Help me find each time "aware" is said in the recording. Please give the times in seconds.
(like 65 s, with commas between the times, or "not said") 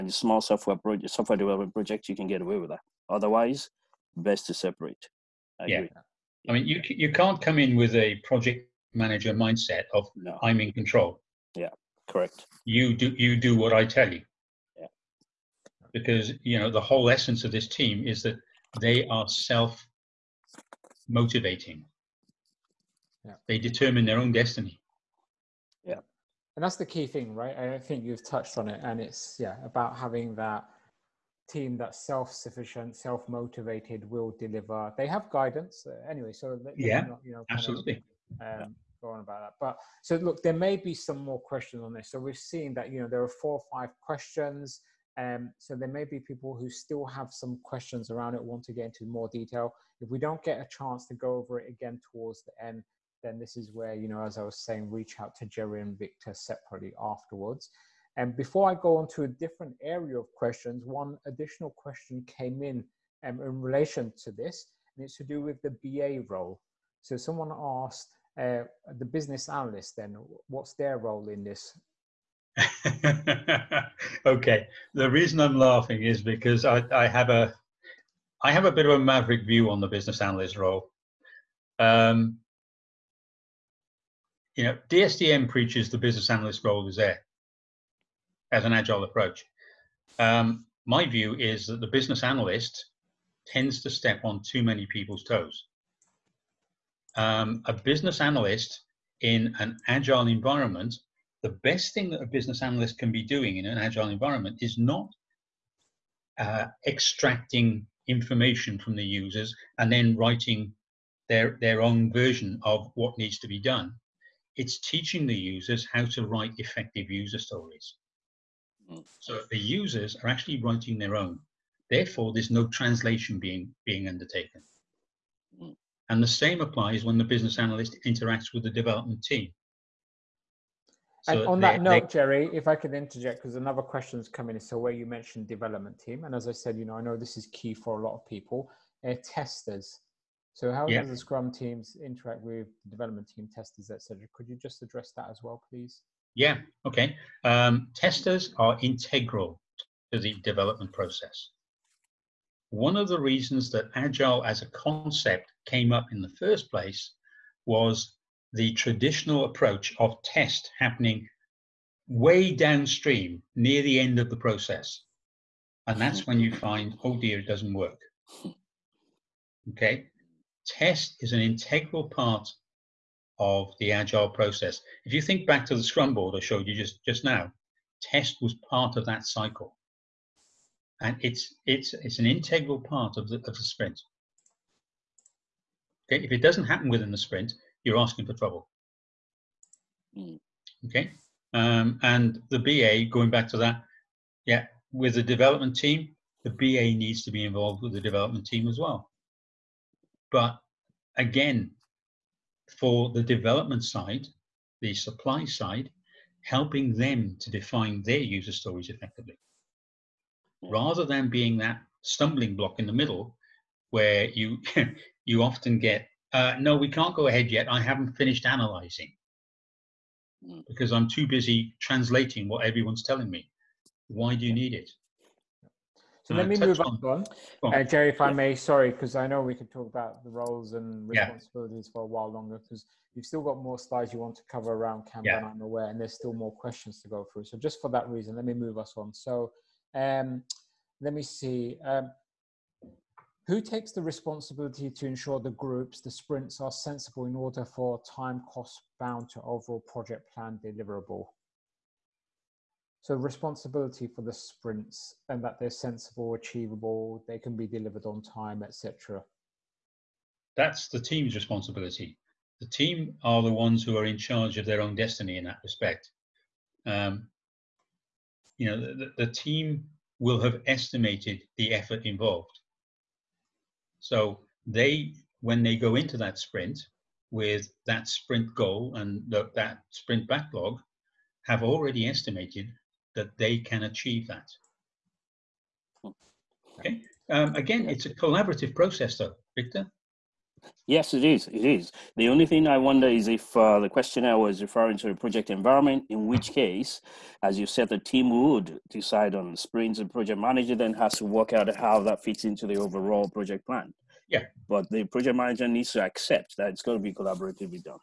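235 s.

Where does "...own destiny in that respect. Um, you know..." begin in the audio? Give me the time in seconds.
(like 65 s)
264 s.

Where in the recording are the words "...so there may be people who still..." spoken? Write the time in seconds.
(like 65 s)
45 s.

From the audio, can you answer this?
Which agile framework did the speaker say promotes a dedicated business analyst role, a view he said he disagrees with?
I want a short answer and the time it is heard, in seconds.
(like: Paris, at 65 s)
DSDM, at 84 s.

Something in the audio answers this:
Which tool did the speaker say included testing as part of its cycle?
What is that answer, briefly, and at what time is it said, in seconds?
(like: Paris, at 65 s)
the Scrum board, at 175 s.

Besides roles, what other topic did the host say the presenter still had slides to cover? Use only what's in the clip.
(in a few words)
Kanban.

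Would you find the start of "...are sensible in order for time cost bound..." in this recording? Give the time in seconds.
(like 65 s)
246 s.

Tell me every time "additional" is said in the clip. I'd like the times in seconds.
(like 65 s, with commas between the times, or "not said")
61 s.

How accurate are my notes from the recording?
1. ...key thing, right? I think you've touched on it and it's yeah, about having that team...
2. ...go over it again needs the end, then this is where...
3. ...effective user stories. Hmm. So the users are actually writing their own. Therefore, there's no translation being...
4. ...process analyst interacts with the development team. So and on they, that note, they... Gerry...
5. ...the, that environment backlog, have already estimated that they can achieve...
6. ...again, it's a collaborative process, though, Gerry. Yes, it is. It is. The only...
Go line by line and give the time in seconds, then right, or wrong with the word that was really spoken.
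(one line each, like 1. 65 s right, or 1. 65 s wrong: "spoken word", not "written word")
1. 26 s right
2. 51 s wrong: "towards", not "needs"
3. 116 s right
4. 127 s wrong: "business", not "process"
5. 279 s wrong: "sprint", not "environment"
6. 287 s wrong: "Victor", not "Gerry".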